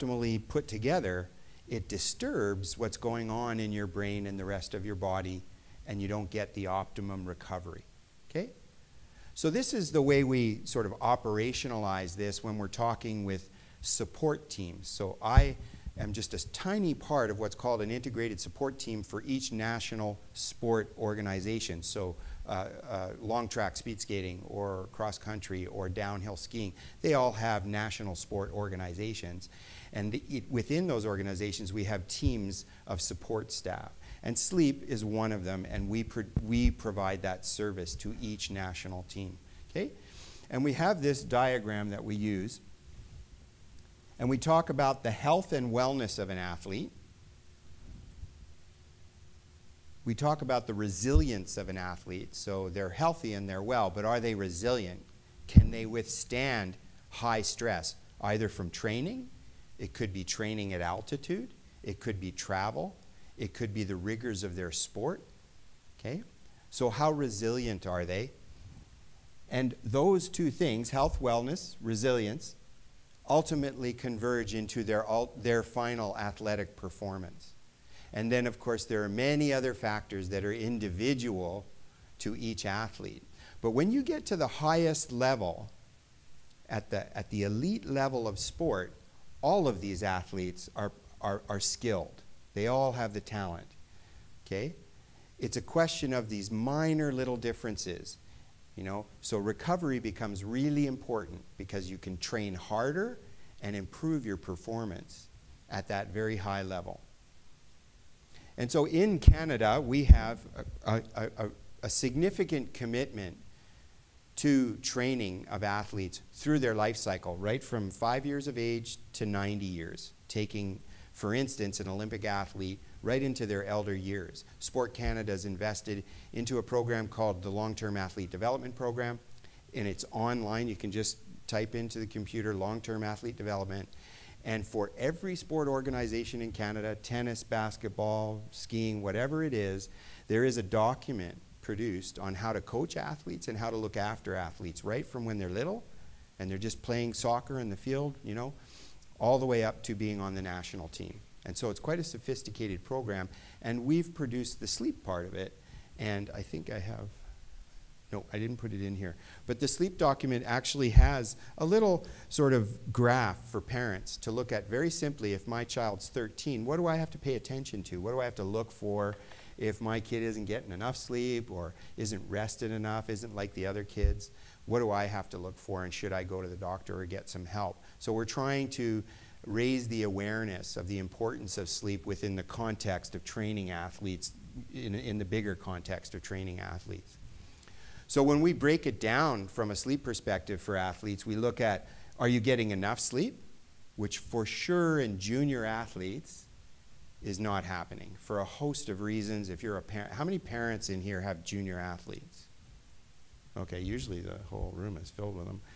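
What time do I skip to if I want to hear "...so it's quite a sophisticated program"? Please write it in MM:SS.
02:31.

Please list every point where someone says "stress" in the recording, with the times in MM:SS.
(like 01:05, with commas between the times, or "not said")
00:57.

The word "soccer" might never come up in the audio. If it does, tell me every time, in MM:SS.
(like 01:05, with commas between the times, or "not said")
02:27.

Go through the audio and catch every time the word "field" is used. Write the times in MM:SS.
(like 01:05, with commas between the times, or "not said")
02:27.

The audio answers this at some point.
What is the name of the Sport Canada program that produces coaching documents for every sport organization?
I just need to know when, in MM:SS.
02:07.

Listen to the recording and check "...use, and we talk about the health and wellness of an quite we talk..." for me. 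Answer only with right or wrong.
wrong.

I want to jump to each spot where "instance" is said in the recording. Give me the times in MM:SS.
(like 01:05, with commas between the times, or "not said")
02:01.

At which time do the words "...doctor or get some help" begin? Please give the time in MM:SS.
02:56.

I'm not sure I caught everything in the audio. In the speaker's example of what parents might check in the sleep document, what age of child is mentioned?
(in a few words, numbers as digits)
13.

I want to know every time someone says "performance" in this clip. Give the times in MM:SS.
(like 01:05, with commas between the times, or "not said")
01:16, 01:44.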